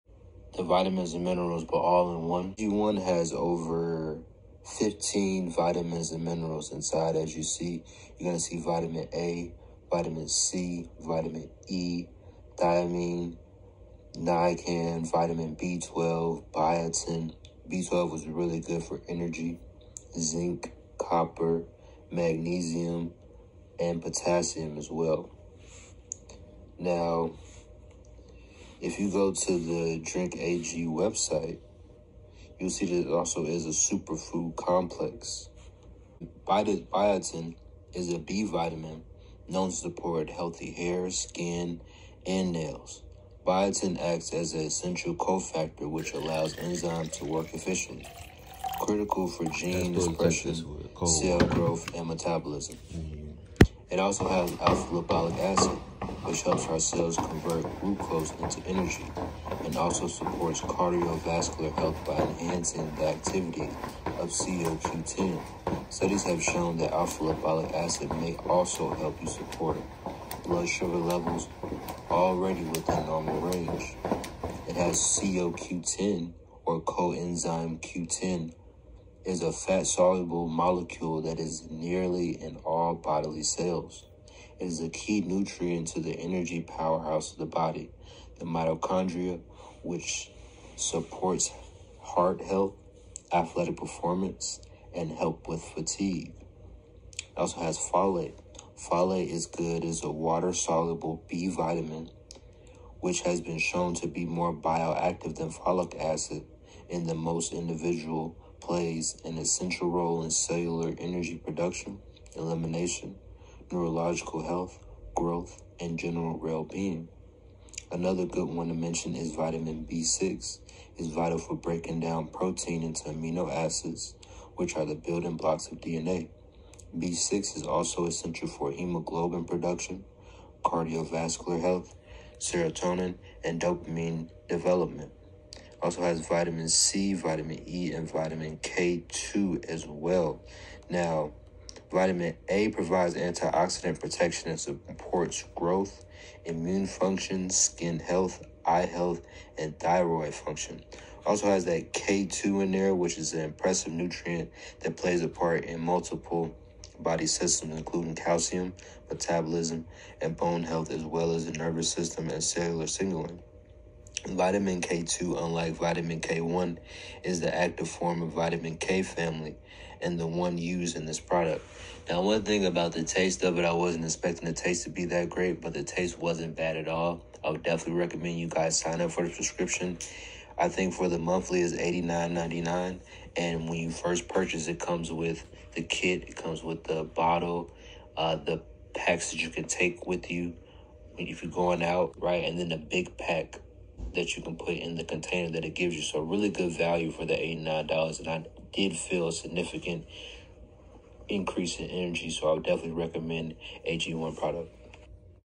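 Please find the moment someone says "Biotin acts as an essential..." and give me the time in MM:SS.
00:43.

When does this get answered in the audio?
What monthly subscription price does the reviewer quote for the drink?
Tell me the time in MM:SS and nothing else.
03:01.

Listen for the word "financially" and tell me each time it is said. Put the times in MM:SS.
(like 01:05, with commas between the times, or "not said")
not said.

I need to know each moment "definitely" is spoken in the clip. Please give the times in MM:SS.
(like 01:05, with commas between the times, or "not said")
02:57, 03:22.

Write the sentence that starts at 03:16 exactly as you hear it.
So really good value for the $89.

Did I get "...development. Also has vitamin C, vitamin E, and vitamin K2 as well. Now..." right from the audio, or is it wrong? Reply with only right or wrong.
right.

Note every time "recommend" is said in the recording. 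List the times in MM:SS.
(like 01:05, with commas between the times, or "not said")
02:57, 03:23.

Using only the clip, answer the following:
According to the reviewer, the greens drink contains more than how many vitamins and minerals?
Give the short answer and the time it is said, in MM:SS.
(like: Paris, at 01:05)
15, at 00:03.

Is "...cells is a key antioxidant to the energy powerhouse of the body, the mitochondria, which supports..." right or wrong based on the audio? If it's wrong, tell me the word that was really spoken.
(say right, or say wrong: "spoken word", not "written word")
wrong: "nutrient", not "antioxidant".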